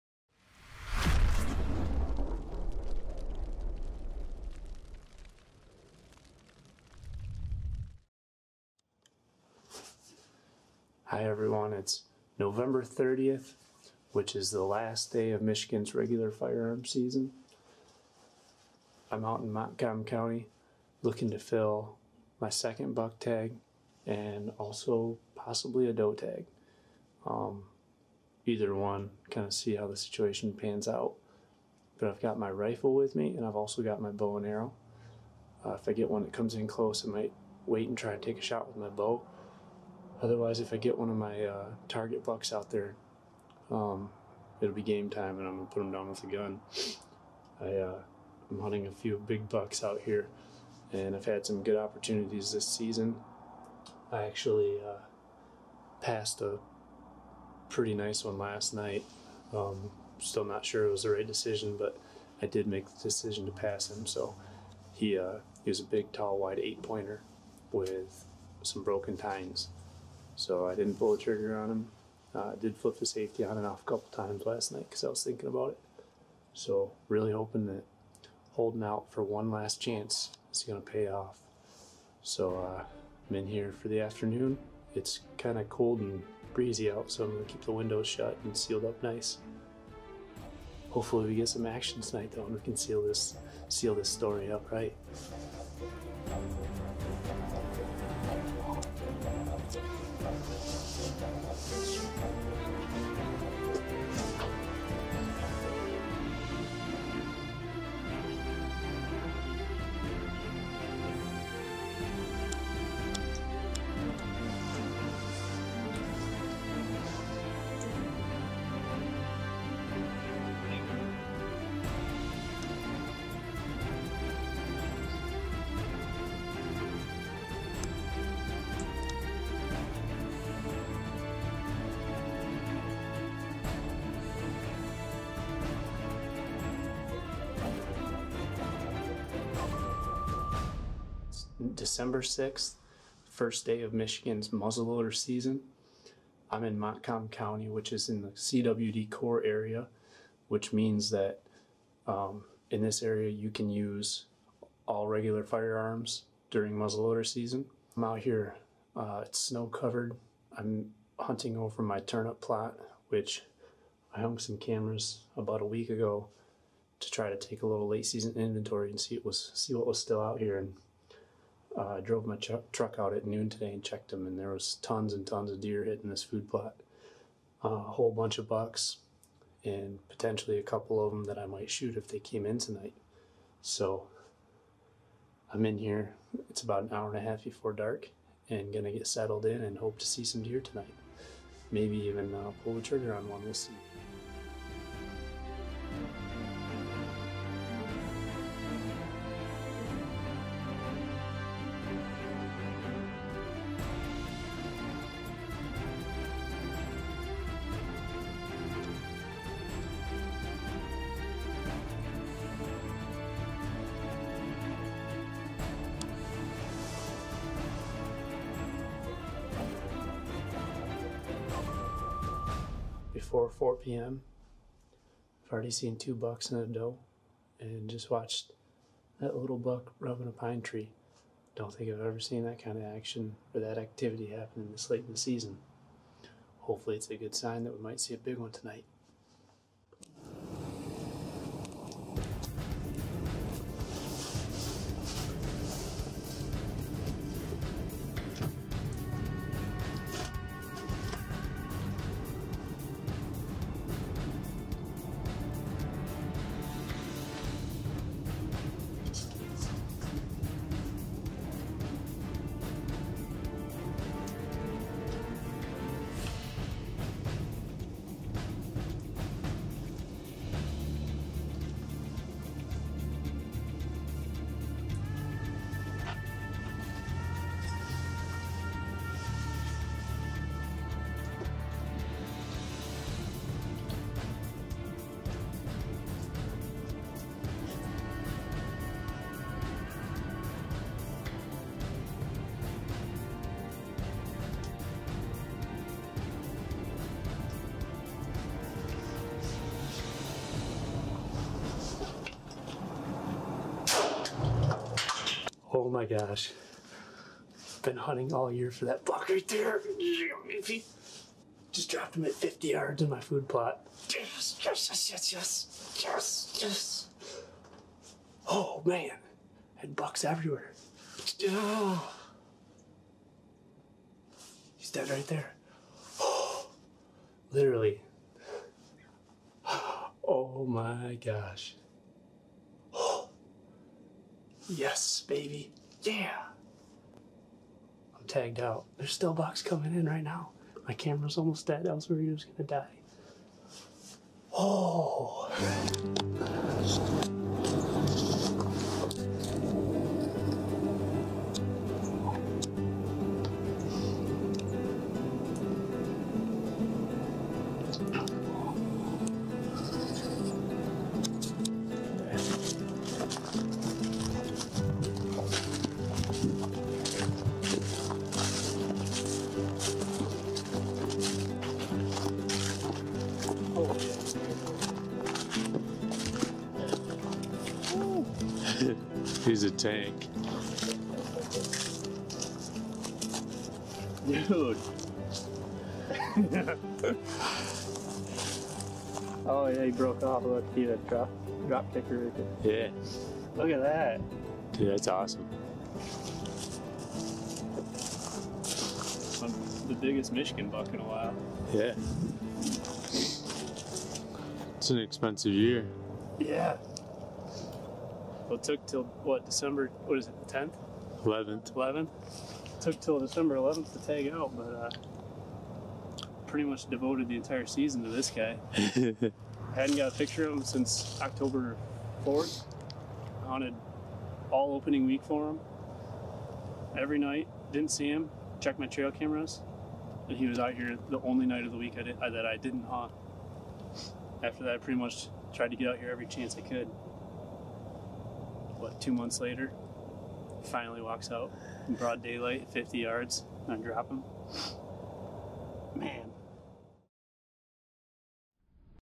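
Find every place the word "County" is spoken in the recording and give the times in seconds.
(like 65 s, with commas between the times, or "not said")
20 s, 147 s.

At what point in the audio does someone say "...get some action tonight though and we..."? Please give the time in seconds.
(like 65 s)
91 s.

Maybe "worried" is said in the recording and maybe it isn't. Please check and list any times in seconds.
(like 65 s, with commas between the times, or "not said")
342 s.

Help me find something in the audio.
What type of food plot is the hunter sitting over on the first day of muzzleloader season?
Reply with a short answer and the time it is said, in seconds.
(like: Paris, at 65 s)
Turnip plot, at 161 s.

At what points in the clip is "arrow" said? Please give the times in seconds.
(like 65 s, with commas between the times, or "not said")
34 s.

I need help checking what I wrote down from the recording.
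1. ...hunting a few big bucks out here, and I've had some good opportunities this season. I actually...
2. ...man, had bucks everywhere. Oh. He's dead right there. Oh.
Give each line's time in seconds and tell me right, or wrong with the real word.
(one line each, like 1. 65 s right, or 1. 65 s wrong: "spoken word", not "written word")
1. 48 s right
2. 318 s right.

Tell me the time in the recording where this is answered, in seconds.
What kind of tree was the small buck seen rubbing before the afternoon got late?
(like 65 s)
230 s.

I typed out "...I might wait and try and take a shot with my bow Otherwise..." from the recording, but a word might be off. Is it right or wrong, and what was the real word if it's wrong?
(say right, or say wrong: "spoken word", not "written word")
right.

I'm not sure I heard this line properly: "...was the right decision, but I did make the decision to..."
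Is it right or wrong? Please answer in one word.
right.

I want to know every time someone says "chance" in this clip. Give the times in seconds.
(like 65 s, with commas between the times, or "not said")
79 s, 436 s.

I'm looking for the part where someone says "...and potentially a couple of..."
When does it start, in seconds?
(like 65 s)
179 s.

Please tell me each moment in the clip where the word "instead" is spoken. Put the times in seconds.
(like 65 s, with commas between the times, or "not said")
not said.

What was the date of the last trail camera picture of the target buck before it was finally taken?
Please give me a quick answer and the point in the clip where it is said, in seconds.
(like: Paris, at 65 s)
October 4th, at 421 s.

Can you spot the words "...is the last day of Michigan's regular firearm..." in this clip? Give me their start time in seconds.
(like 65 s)
14 s.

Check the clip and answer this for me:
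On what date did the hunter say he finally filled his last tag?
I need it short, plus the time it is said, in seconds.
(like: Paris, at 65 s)
December 11th, at 413 s.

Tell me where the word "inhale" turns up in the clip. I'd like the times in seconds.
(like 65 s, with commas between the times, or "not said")
not said.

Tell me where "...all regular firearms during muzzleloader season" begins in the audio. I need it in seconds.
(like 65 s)
154 s.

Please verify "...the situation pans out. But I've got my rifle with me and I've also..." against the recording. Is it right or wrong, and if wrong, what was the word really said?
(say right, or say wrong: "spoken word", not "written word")
right.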